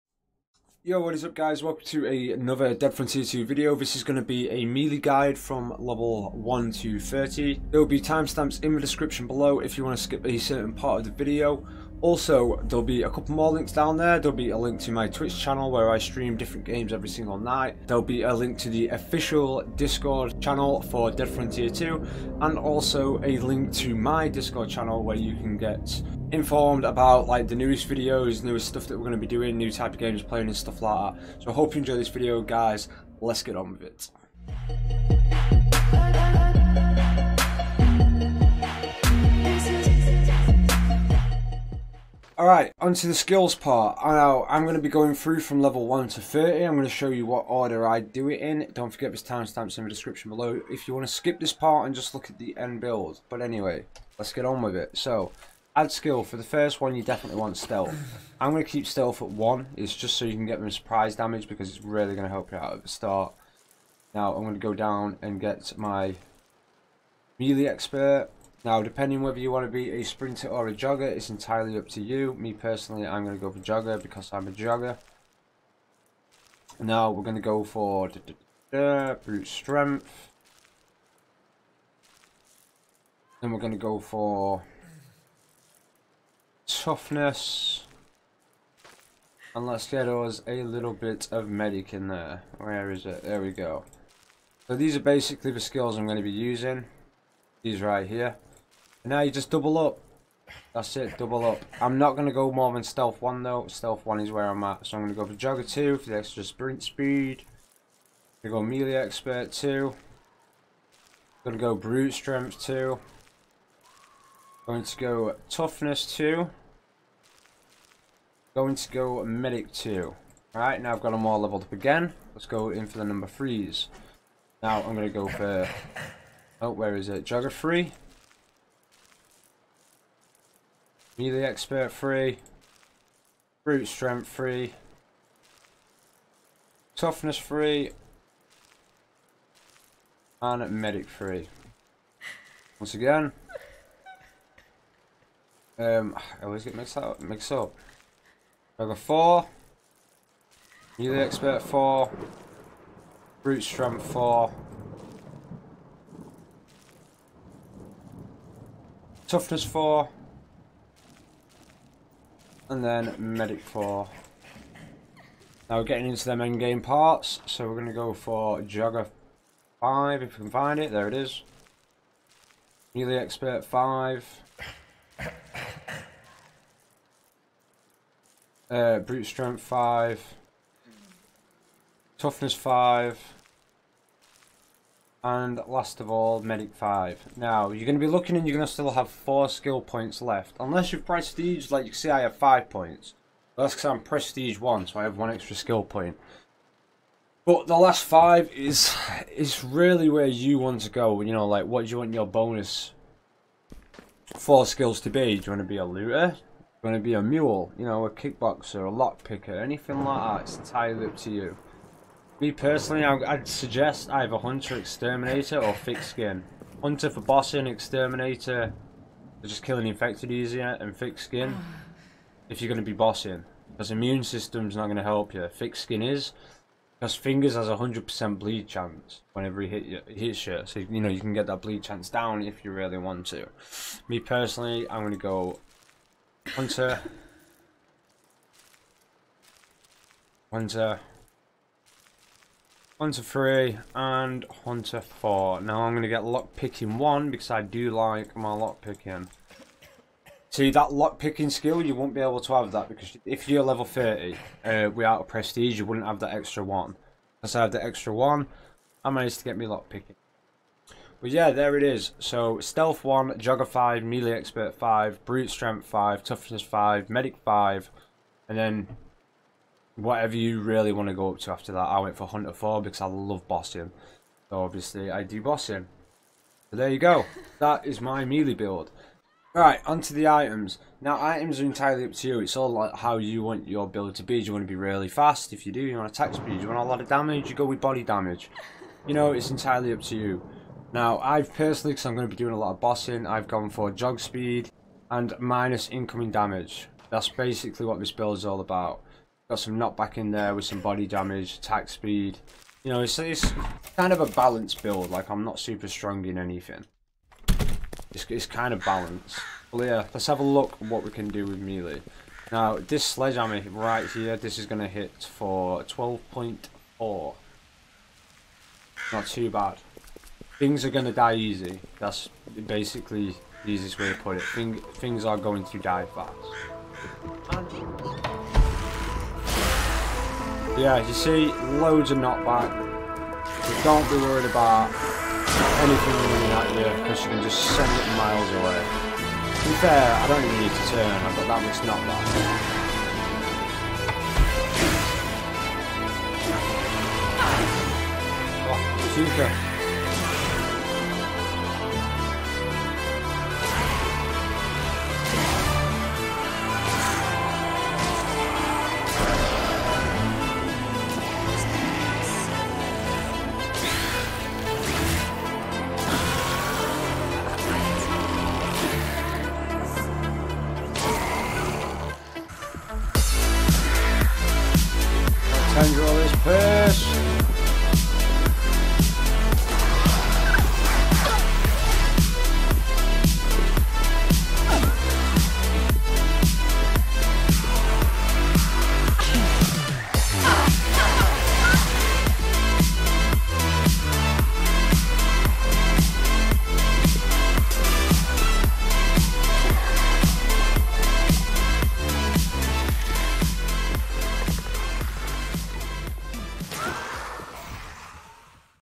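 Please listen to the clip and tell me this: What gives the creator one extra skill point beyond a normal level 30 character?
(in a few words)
Prestige 1.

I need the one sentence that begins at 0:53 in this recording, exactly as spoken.
But anyway, let's get on with it.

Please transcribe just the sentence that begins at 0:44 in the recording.
I know I'm going to be going through from level 1 to 30.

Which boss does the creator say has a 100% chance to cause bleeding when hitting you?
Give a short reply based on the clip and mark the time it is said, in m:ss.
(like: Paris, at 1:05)
Fingers, at 3:47.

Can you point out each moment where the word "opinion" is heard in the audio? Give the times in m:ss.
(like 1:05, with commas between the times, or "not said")
not said.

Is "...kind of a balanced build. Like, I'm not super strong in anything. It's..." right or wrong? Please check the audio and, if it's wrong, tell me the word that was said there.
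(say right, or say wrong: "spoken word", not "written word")
right.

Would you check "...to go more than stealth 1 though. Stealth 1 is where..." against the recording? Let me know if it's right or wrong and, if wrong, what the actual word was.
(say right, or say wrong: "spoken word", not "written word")
right.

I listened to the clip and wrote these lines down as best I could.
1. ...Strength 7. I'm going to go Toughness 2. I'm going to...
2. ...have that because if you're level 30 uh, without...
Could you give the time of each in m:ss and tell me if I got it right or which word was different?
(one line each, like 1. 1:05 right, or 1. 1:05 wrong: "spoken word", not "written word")
1. 1:52 wrong: "2", not "7"
2. 4:12 right.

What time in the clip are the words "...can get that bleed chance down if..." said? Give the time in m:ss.
3:51.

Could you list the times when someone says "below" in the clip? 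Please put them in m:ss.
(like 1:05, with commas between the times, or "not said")
0:09, 0:50.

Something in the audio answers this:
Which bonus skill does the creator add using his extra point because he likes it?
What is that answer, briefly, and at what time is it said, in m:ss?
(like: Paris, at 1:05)
Lockpicking 1, at 4:06.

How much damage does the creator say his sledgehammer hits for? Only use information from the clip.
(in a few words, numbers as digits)
12.4.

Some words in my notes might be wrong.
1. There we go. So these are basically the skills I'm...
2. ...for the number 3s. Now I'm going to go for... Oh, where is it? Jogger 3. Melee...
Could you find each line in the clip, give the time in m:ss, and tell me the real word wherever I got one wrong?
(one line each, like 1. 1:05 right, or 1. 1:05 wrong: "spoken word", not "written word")
1. 1:33 right
2. 2:02 right.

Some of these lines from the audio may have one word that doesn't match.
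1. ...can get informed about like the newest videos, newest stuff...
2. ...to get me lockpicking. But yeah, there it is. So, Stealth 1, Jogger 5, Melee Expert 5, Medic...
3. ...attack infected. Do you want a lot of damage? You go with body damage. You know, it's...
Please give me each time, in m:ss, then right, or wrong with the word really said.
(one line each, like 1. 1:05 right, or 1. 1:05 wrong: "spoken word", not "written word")
1. 0:25 right
2. 4:19 wrong: "Brute", not "Medic"
3. 4:46 wrong: "speed", not "infected".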